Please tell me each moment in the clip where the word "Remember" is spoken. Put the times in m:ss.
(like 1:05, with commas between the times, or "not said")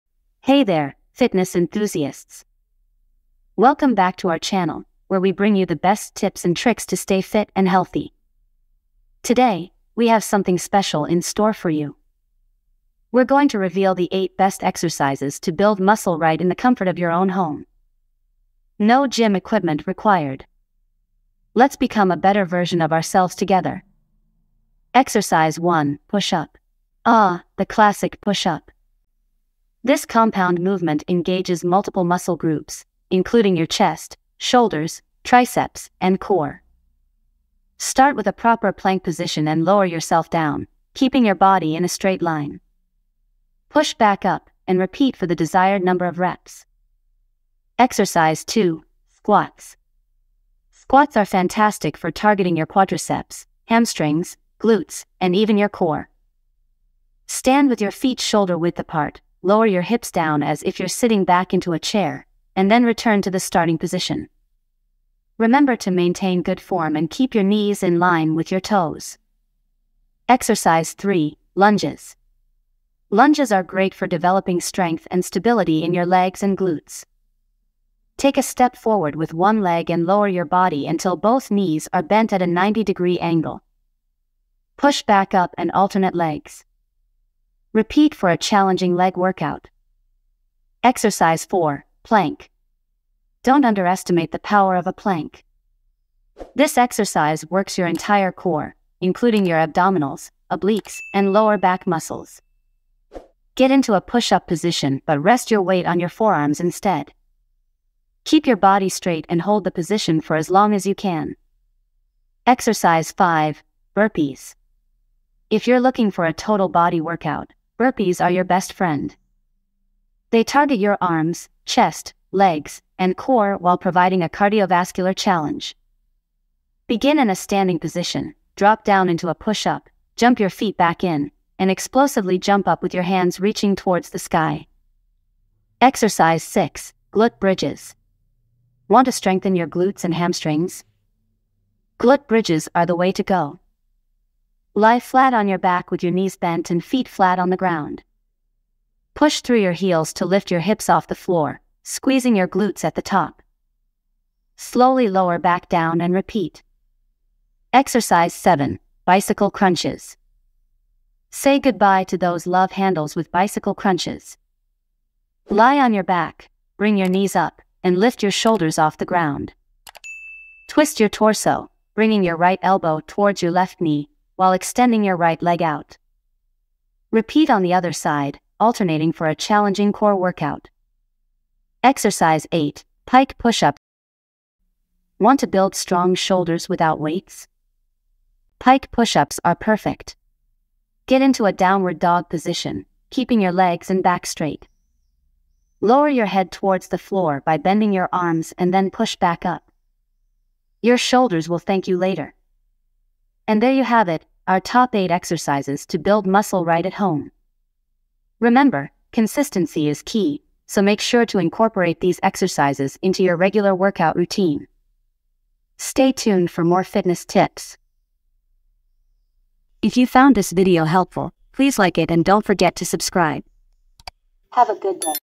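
1:05, 3:28.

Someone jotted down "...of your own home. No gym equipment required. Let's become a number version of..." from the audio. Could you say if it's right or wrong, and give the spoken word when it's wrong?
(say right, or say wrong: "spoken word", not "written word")
wrong: "better", not "number".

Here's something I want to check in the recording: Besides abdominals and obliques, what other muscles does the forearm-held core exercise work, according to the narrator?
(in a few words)
Lower back muscles.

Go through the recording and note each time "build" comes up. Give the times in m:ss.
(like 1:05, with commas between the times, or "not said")
0:15, 3:05, 3:25.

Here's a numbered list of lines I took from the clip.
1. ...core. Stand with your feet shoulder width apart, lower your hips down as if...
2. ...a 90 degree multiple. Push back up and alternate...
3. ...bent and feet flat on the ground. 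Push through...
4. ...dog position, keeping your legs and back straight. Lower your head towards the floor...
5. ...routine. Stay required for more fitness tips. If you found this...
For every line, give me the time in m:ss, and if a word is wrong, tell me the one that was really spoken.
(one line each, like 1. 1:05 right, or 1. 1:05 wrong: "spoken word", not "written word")
1. 0:55 right
2. 1:22 wrong: "angle", not "multiple"
3. 2:26 right
4. 3:11 right
5. 3:34 wrong: "tuned", not "required".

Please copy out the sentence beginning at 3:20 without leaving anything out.
Your shoulders will thank you later.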